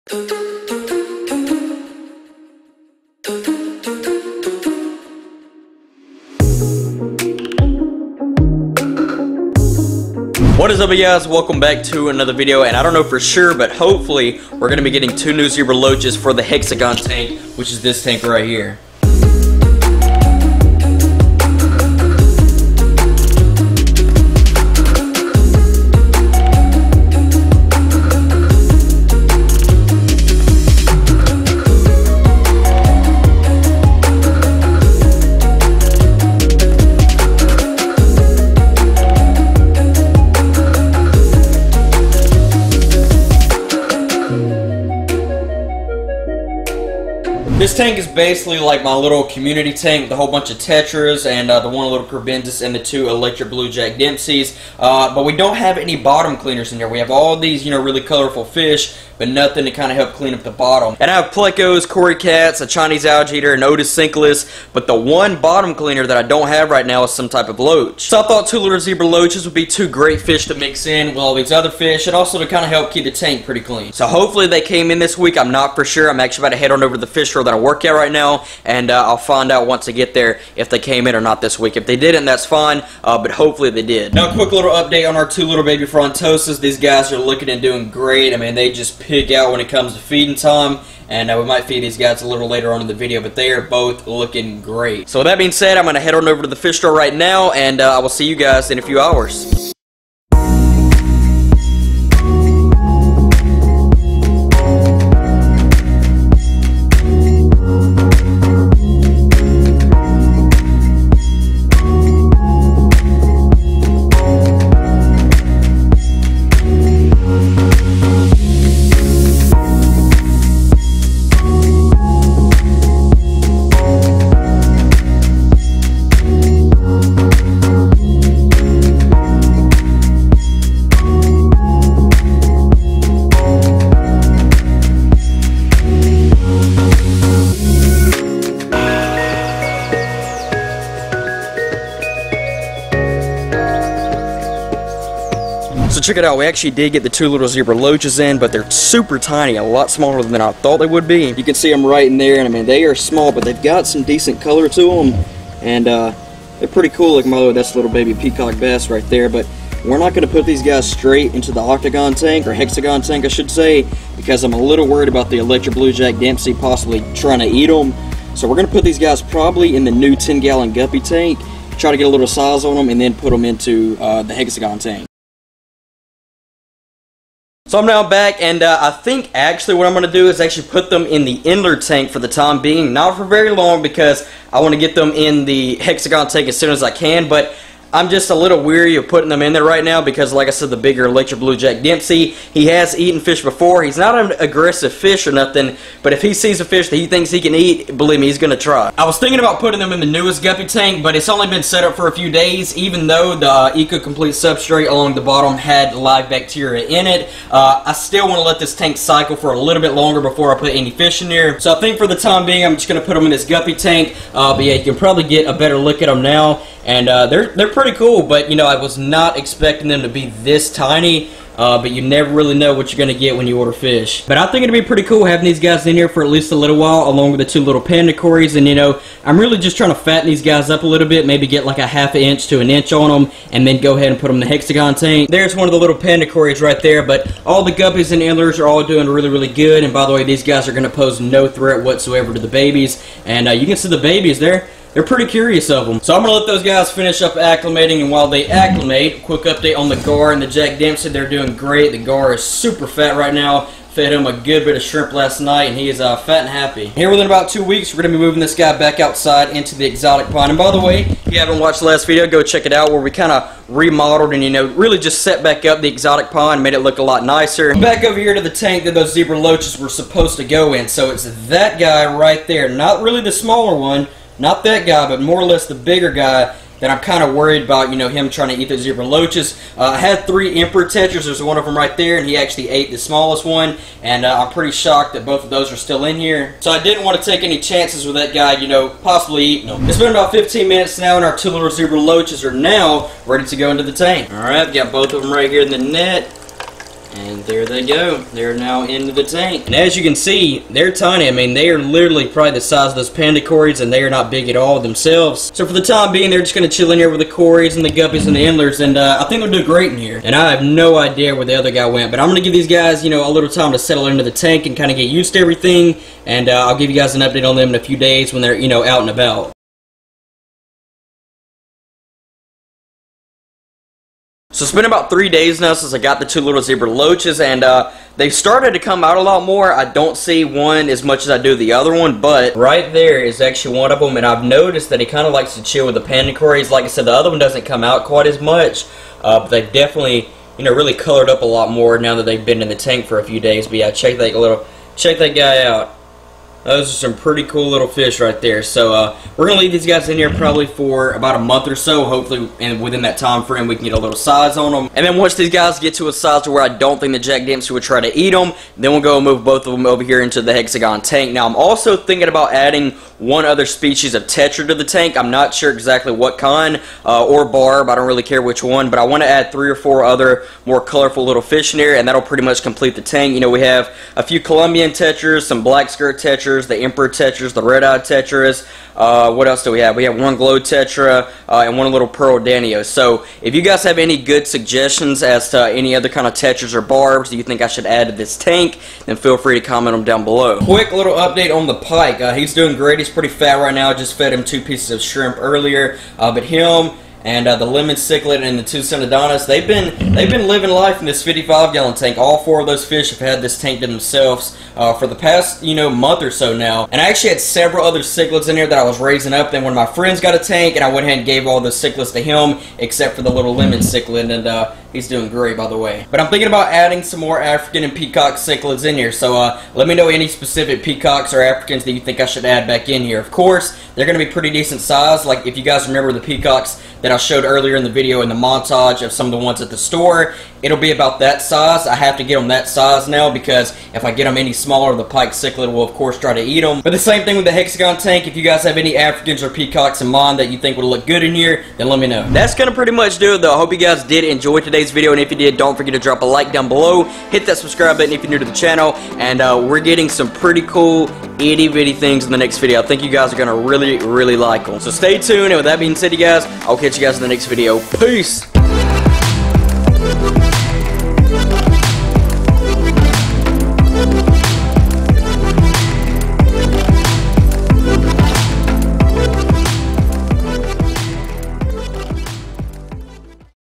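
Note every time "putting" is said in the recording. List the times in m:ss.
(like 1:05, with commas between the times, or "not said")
3:09, 3:19.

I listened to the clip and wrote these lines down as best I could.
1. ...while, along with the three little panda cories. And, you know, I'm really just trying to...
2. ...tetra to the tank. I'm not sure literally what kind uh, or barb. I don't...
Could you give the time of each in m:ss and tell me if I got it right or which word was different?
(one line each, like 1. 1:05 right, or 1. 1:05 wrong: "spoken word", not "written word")
1. 3:46 wrong: "two", not "three"
2. 6:04 wrong: "exactly", not "literally".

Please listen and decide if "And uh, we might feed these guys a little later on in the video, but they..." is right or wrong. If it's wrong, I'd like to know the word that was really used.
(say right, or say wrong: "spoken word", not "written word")
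right.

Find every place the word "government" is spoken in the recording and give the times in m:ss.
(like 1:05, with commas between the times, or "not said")
not said.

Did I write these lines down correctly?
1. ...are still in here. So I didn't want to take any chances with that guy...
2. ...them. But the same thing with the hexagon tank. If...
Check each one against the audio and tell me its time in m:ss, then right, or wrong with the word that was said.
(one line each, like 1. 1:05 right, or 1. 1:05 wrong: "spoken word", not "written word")
1. 4:45 right
2. 7:16 right.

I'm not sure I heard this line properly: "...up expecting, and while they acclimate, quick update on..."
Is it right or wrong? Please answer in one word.
wrong.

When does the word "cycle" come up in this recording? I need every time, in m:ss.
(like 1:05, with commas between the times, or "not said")
3:28.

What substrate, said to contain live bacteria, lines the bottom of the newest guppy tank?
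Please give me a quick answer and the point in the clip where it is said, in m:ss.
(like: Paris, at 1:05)
Eco Complete, at 3:23.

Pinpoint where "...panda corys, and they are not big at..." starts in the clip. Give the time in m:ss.
5:03.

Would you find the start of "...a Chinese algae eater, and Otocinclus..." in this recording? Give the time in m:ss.
1:02.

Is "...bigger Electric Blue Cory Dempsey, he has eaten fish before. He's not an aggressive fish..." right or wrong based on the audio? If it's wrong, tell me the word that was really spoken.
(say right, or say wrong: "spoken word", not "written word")
wrong: "Jack", not "Cory".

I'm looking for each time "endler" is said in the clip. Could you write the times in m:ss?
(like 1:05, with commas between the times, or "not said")
3:01, 3:58, 5:08.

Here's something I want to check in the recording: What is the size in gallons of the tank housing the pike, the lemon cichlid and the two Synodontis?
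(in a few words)
55.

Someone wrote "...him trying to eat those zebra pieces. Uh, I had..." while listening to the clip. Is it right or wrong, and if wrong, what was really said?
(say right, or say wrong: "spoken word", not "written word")
wrong: "loaches", not "pieces".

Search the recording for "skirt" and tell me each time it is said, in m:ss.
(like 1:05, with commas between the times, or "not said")
6:15.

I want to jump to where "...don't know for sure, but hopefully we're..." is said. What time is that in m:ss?
0:12.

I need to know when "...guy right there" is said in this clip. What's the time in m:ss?
4:31.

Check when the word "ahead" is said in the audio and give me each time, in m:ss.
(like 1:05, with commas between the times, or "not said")
3:53, 6:51.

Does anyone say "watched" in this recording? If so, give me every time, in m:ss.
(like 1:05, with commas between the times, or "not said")
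4:21.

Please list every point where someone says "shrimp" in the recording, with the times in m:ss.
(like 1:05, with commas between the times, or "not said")
4:14, 6:35.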